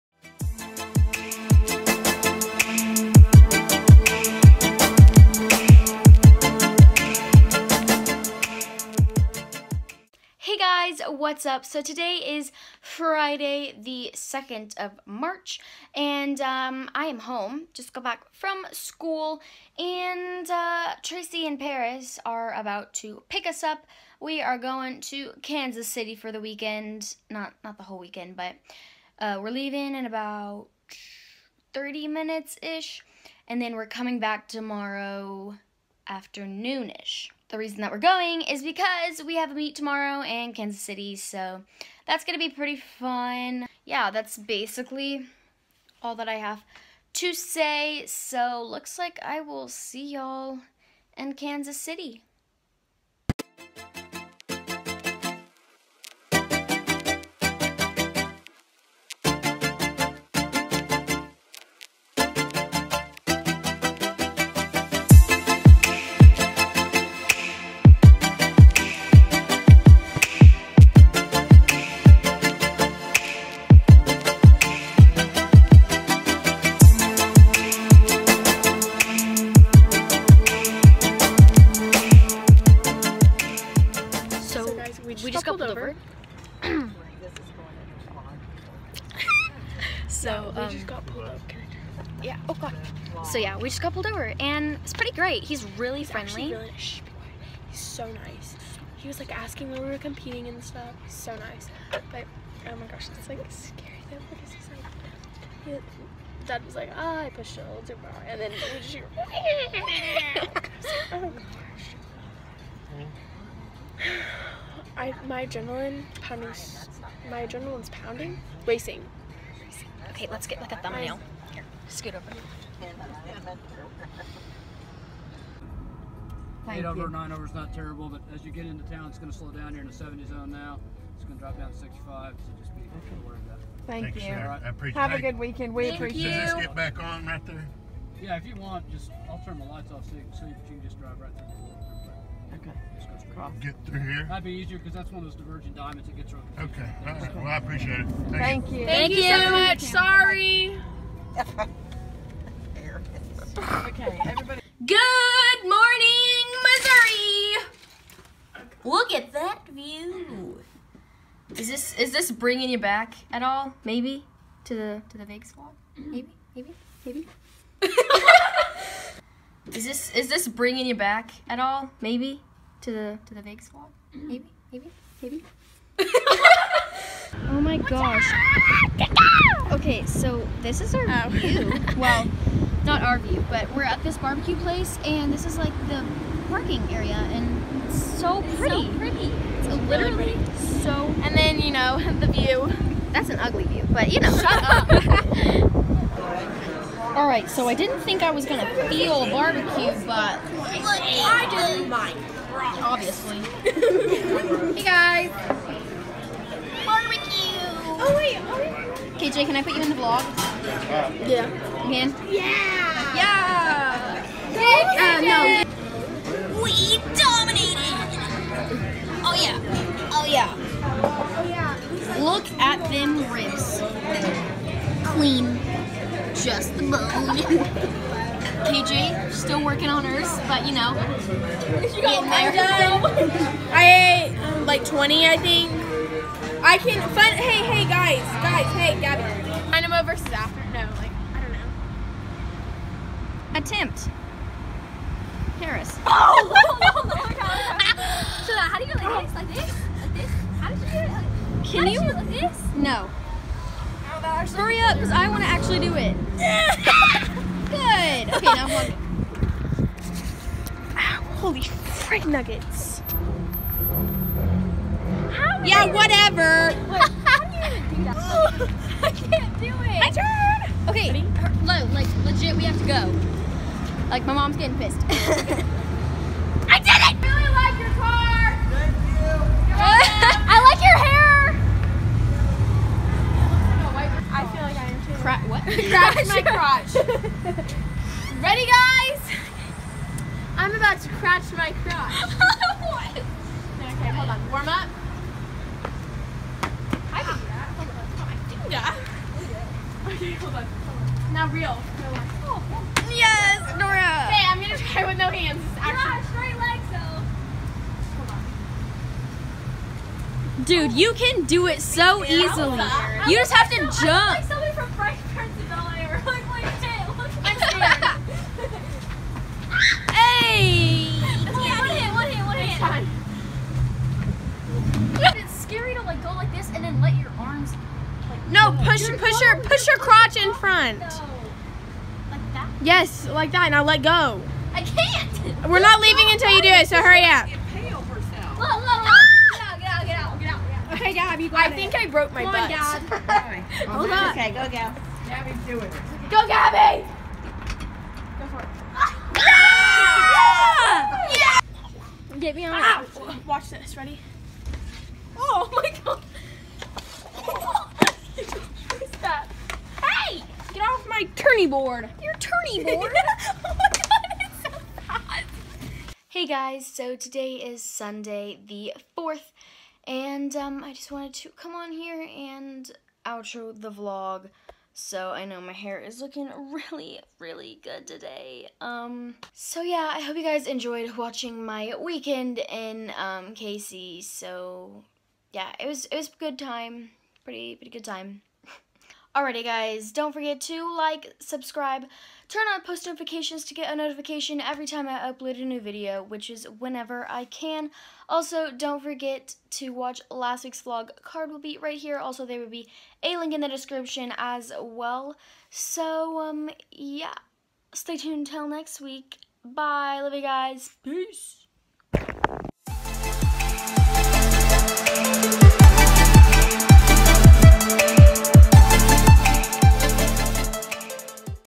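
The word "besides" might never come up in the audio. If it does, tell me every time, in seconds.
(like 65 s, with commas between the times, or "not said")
not said.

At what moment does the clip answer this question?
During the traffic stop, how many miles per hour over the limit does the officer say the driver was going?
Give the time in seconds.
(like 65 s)
127 s.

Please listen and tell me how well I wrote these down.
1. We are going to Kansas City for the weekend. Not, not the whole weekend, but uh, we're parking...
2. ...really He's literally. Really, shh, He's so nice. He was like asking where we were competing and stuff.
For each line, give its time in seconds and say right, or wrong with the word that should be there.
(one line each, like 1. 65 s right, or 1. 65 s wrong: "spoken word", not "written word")
1. 24 s wrong: "leaving", not "parking"
2. 95 s wrong: "friendly", not "literally".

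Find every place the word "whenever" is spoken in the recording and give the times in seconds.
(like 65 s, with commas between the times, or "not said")
396 s.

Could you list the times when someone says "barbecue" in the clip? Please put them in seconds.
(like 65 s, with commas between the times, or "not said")
184 s, 199 s, 206 s.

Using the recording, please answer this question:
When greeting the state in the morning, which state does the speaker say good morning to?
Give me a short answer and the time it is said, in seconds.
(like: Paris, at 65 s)
Missouri, at 156 s.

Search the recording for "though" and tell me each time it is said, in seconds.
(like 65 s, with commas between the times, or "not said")
104 s, 310 s.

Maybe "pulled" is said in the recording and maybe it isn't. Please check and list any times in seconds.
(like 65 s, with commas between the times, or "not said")
85 s, 93 s.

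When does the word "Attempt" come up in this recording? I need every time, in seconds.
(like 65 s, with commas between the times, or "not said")
243 s.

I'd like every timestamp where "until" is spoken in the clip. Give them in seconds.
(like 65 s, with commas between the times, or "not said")
336 s, 408 s.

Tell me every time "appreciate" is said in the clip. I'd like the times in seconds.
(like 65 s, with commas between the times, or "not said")
135 s, 147 s.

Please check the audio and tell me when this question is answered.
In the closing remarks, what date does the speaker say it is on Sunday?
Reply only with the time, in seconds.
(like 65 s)
367 s.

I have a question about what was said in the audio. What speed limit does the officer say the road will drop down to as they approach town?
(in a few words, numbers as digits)
65.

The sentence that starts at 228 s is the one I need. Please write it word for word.
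KJ, still working on hers, but you know.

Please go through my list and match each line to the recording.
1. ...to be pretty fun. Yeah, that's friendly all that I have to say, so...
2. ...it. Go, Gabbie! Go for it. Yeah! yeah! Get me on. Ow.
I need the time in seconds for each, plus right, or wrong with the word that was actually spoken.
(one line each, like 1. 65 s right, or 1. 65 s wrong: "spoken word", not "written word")
1. 42 s wrong: "basically", not "friendly"
2. 345 s right.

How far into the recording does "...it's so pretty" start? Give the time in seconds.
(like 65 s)
187 s.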